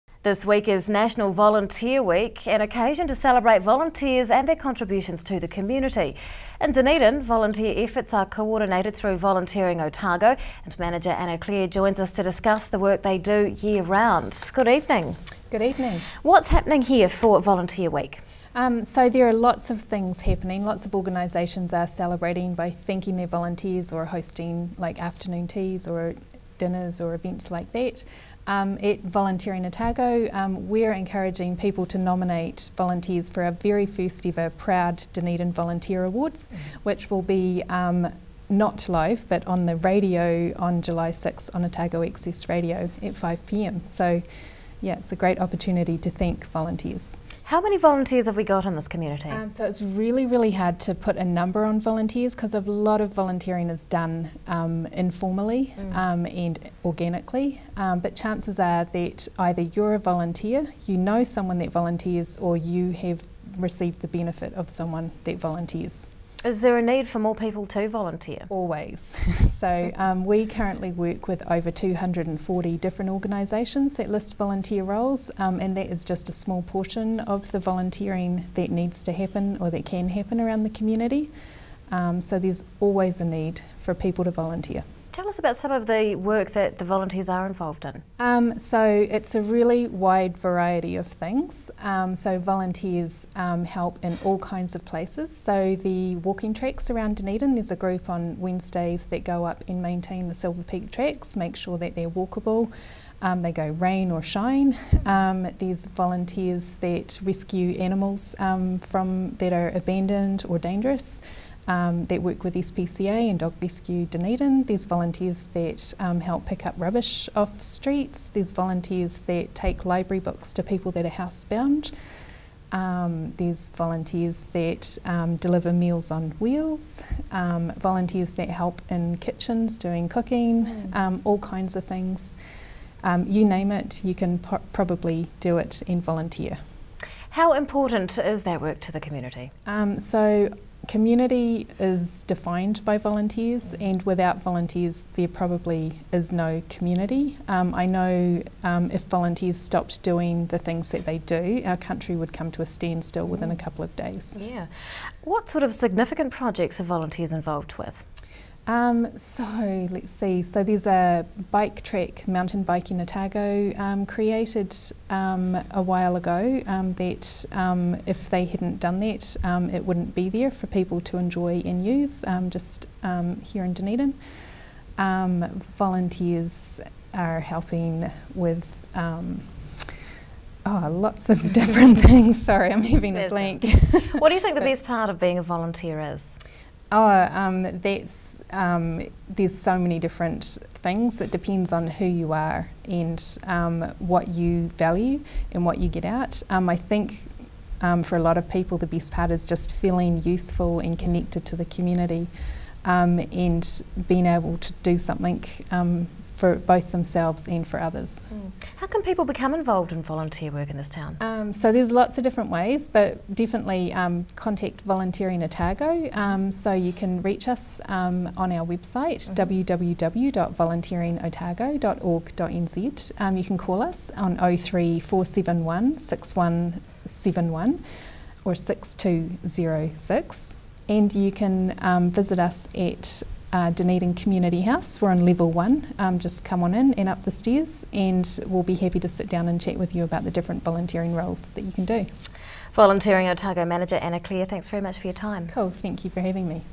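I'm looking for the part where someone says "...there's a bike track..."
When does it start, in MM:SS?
02:40.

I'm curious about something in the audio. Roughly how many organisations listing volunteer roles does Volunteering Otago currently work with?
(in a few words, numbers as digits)
over 240.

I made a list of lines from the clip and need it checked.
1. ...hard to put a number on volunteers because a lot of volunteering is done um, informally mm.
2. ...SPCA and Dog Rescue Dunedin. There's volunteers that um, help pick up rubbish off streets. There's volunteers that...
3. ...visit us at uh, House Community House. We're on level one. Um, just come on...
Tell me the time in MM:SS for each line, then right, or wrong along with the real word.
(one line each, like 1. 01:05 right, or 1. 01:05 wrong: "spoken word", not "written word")
1. 00:50 right
2. 01:52 right
3. 03:52 wrong: "Dunedin", not "House".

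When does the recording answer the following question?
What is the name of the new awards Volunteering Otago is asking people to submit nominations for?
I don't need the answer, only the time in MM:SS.
00:34.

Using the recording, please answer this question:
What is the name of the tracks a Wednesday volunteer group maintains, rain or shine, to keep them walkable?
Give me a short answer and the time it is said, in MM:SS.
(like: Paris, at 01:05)
Silver Peak tracks, at 01:40.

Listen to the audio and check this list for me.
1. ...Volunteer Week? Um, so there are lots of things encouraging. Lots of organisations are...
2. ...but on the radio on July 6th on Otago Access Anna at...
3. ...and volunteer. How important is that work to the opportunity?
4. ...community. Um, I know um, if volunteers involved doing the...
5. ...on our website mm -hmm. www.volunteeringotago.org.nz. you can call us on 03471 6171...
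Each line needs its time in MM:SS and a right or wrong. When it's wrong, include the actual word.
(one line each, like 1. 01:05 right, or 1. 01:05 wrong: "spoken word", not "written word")
1. 00:17 wrong: "happening", not "encouraging"
2. 00:39 wrong: "Radio", not "Anna"
3. 02:15 wrong: "community", not "opportunity"
4. 02:26 wrong: "stopped", not "involved"
5. 03:38 right.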